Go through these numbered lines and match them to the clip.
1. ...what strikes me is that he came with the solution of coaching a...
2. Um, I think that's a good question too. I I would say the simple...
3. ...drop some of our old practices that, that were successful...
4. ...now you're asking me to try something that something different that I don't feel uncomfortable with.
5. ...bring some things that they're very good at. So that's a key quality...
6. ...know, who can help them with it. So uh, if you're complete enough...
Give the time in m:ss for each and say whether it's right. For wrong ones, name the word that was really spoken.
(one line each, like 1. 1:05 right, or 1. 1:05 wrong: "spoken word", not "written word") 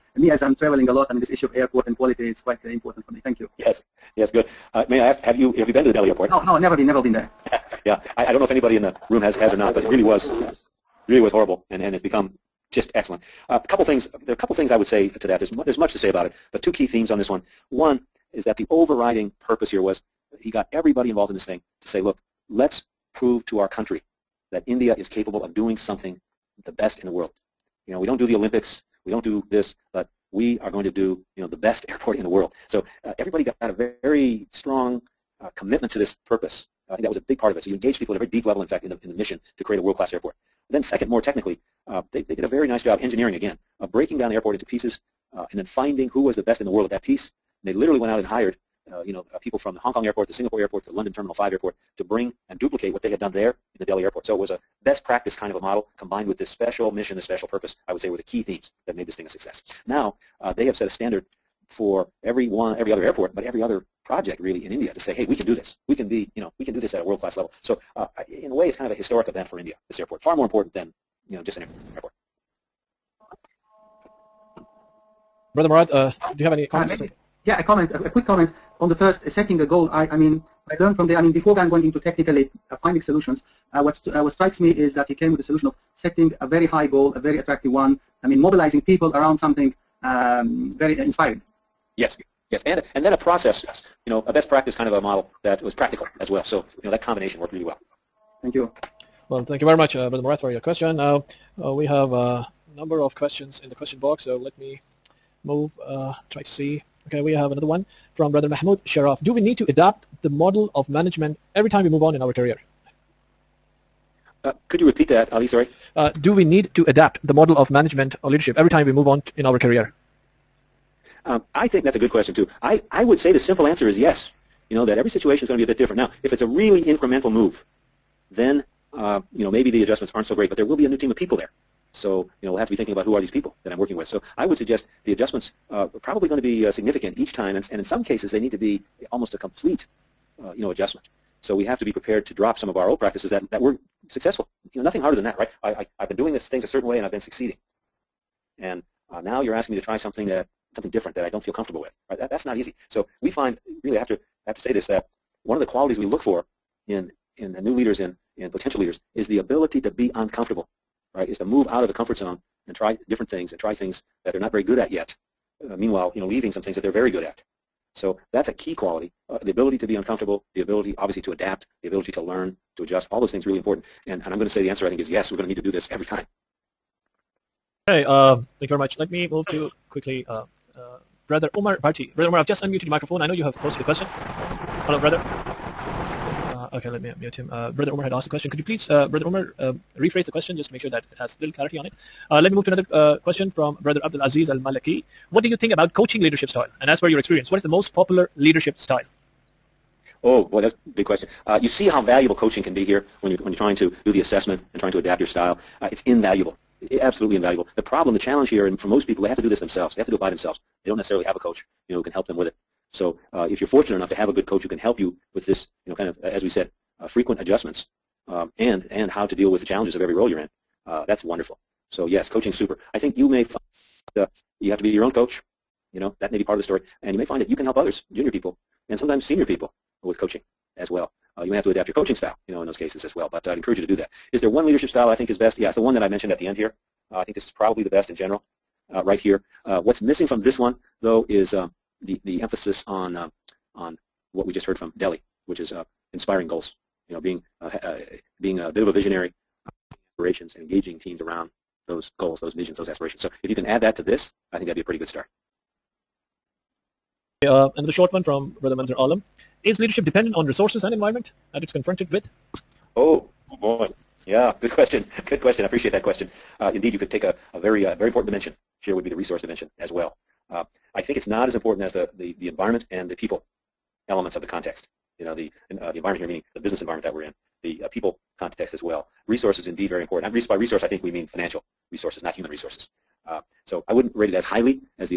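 1. 1:24 wrong: "setting", not "coaching"
2. 2:01 right
3. 2:22 right
4. 2:29 wrong: "comfortable", not "uncomfortable"
5. 2:46 wrong: "leaving", not "bring"
6. 3:31 wrong: "fortunate", not "complete".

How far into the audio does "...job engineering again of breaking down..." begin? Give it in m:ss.
0:42.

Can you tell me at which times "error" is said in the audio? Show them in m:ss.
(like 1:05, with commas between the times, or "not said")
not said.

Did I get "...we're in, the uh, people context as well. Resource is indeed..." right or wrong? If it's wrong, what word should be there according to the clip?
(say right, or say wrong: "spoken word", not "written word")
right.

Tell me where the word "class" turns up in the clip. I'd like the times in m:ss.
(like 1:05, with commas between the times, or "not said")
0:39, 1:07.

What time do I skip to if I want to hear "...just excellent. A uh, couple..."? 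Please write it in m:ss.
0:12.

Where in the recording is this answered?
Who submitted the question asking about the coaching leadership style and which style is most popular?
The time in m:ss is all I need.
3:14.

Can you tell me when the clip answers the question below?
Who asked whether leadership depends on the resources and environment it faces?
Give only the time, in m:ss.
4:18.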